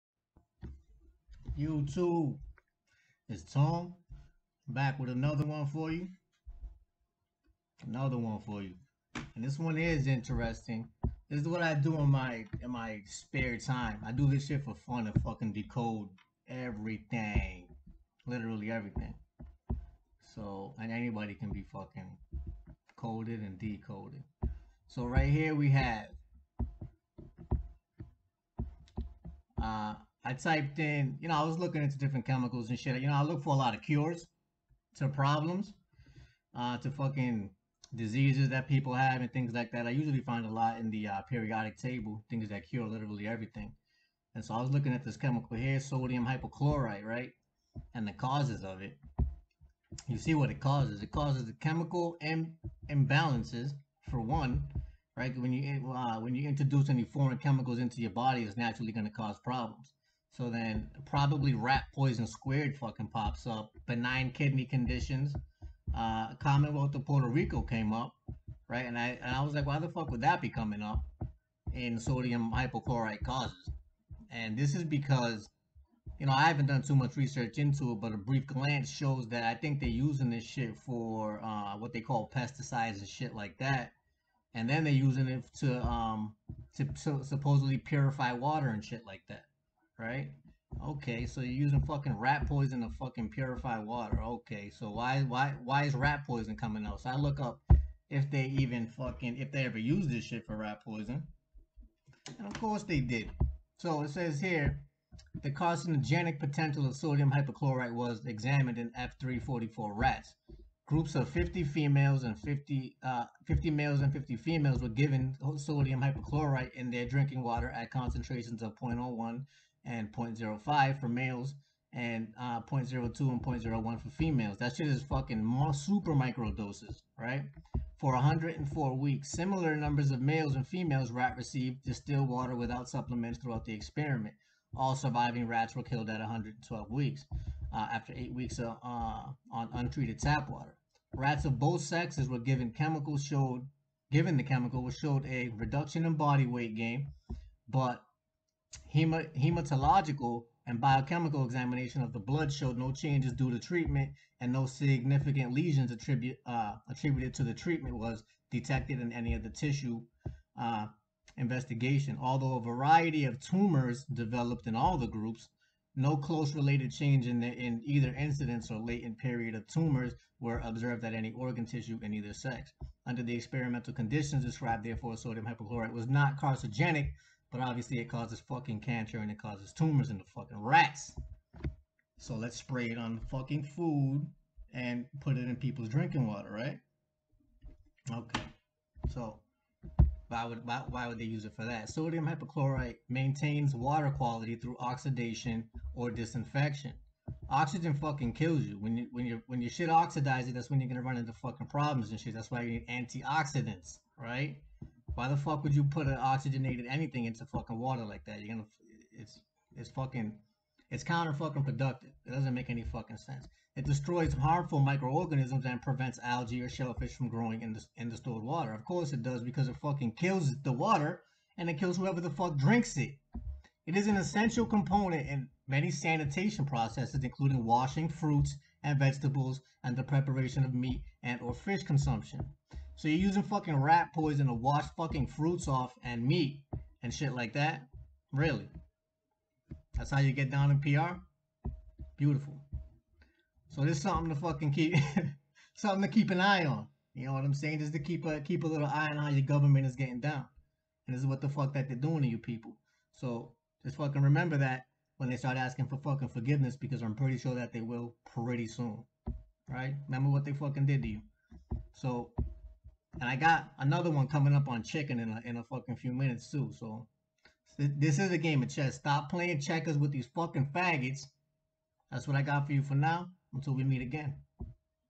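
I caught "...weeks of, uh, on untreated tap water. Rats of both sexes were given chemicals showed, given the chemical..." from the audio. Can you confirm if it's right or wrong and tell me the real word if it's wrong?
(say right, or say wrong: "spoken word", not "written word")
right.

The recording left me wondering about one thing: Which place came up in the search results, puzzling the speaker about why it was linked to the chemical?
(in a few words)
Commonwealth of Puerto Rico.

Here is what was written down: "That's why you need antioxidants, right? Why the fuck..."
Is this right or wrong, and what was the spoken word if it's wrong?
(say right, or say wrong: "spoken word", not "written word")
right.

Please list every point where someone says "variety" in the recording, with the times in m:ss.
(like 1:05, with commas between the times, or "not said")
2:42.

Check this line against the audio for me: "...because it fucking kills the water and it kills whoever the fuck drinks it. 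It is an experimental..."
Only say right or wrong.
wrong.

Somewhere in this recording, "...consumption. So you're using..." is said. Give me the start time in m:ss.
3:51.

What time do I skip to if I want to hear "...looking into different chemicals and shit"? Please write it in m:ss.
0:31.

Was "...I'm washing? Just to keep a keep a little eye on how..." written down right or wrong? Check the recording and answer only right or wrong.
wrong.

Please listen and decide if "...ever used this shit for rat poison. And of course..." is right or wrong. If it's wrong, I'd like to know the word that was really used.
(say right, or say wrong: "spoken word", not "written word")
right.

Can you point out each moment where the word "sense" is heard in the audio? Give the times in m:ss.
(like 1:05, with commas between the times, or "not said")
3:33.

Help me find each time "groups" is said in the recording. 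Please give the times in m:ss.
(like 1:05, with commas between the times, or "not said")
1:50, 2:45.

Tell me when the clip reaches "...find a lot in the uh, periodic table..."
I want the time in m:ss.
0:40.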